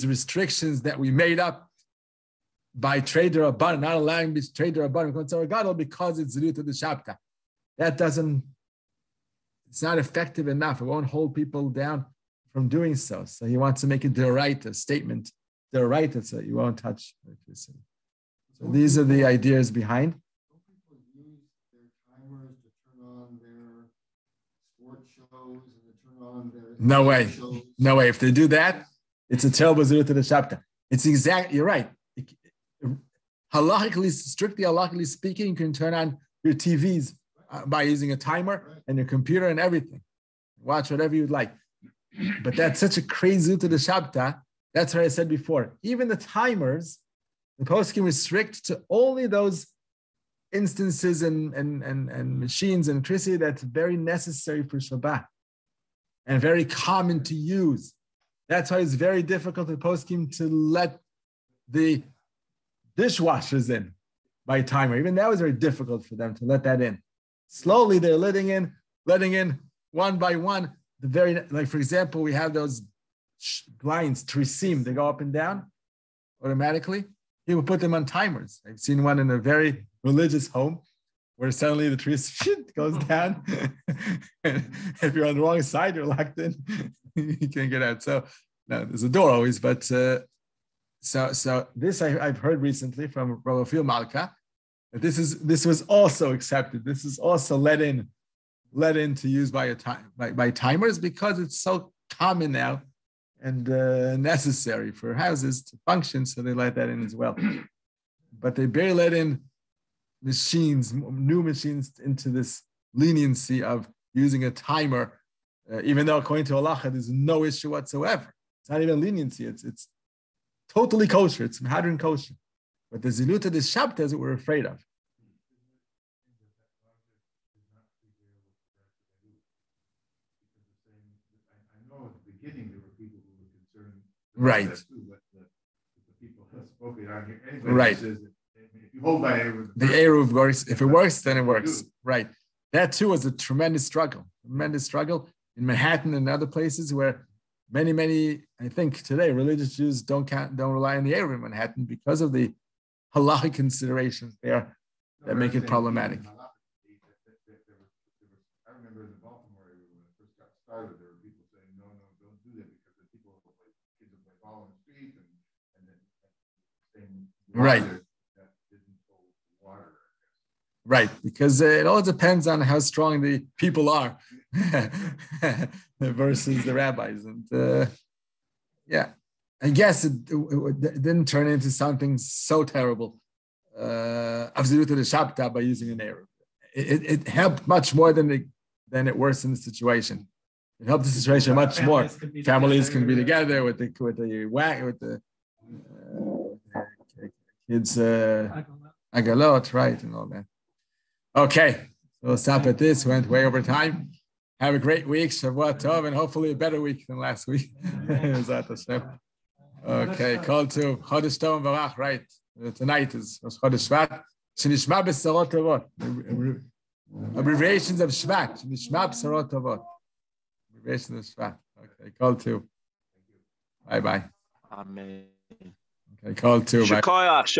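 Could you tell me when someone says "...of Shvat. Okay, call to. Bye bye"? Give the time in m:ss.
3:41.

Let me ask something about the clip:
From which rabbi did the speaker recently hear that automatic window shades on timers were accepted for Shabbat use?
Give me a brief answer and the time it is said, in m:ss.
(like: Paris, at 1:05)
Rabbi Phil Malka, at 1:33.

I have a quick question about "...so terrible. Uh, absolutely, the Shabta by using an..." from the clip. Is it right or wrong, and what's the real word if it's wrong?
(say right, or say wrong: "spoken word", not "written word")
right.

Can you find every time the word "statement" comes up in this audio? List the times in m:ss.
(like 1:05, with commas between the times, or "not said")
0:14.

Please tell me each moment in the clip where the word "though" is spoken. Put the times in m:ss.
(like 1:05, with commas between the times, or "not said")
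1:56.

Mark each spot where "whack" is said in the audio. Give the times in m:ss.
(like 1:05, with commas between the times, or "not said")
3:14.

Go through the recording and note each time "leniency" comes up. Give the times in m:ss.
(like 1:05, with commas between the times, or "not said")
1:52, 1:58.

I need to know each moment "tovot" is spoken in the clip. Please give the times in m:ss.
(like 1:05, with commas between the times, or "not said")
3:35, 3:39.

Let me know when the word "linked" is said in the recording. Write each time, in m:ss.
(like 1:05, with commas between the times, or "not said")
not said.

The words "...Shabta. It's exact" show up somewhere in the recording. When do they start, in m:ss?
0:30.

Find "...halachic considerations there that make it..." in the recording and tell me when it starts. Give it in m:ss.
2:33.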